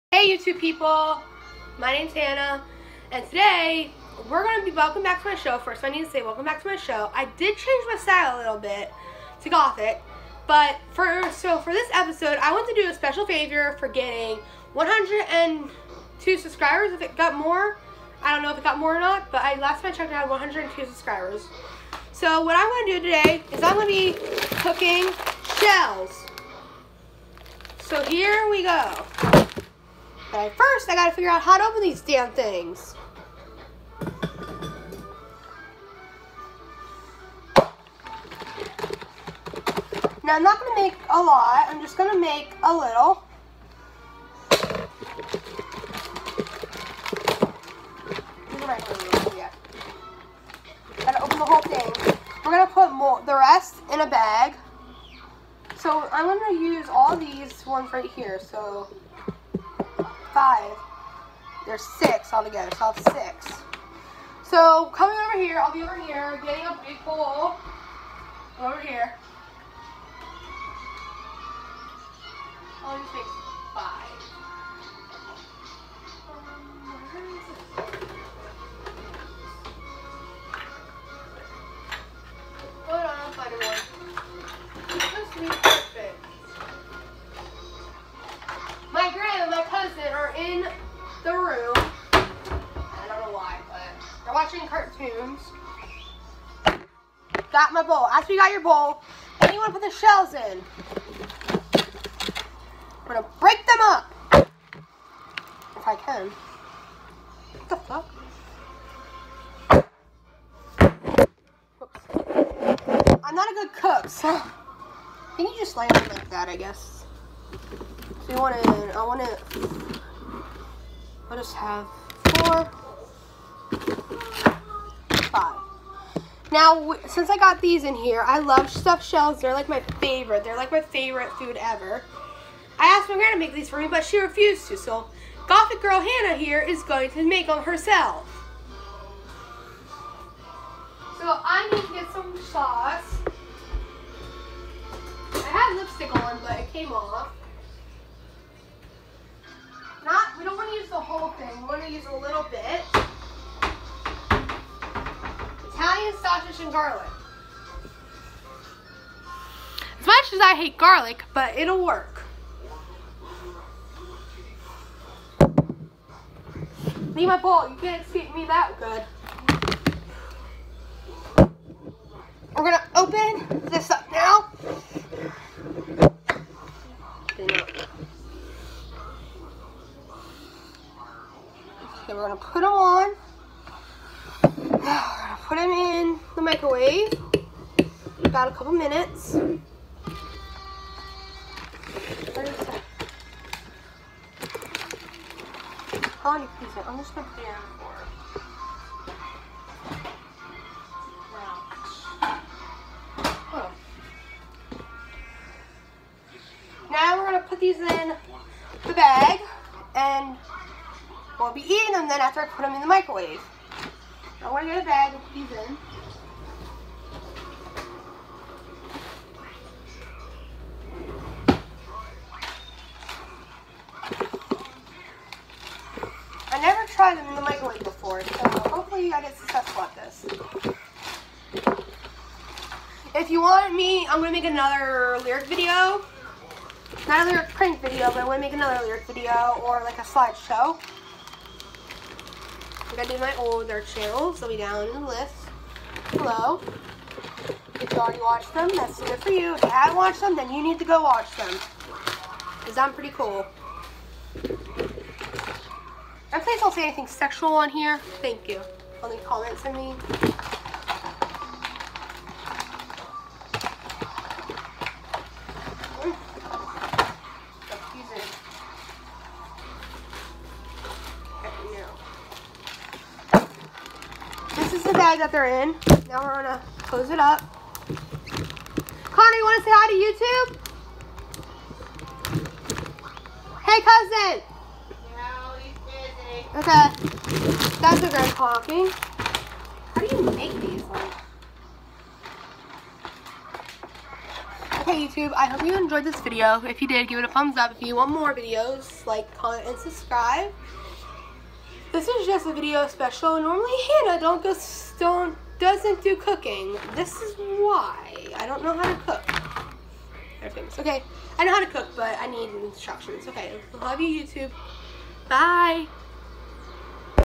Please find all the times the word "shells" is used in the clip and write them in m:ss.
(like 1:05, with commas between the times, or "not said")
0:25, 1:39, 2:09.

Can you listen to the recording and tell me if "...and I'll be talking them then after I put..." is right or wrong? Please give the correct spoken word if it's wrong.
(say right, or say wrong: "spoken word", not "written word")
wrong: "eating", not "talking".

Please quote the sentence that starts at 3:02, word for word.
Okay, we're gonna put them on.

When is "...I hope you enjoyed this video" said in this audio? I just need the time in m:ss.
4:55.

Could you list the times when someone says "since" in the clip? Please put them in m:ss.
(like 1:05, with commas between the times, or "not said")
2:07.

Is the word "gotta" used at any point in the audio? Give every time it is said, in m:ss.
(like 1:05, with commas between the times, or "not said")
0:30, 0:51.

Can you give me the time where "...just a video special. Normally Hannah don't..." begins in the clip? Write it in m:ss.
5:02.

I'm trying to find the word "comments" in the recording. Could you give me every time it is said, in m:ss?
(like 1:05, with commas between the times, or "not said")
4:19, 4:59.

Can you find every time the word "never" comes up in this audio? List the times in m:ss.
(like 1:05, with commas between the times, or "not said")
3:46.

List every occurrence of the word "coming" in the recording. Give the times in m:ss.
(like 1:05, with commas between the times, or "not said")
1:04.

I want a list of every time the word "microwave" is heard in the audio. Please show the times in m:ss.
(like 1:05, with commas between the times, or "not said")
3:06, 3:32, 3:47.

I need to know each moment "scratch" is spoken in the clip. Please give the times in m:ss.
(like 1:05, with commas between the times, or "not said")
not said.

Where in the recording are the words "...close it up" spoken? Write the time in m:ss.
4:36.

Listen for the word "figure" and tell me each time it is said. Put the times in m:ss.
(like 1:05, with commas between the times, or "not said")
0:31.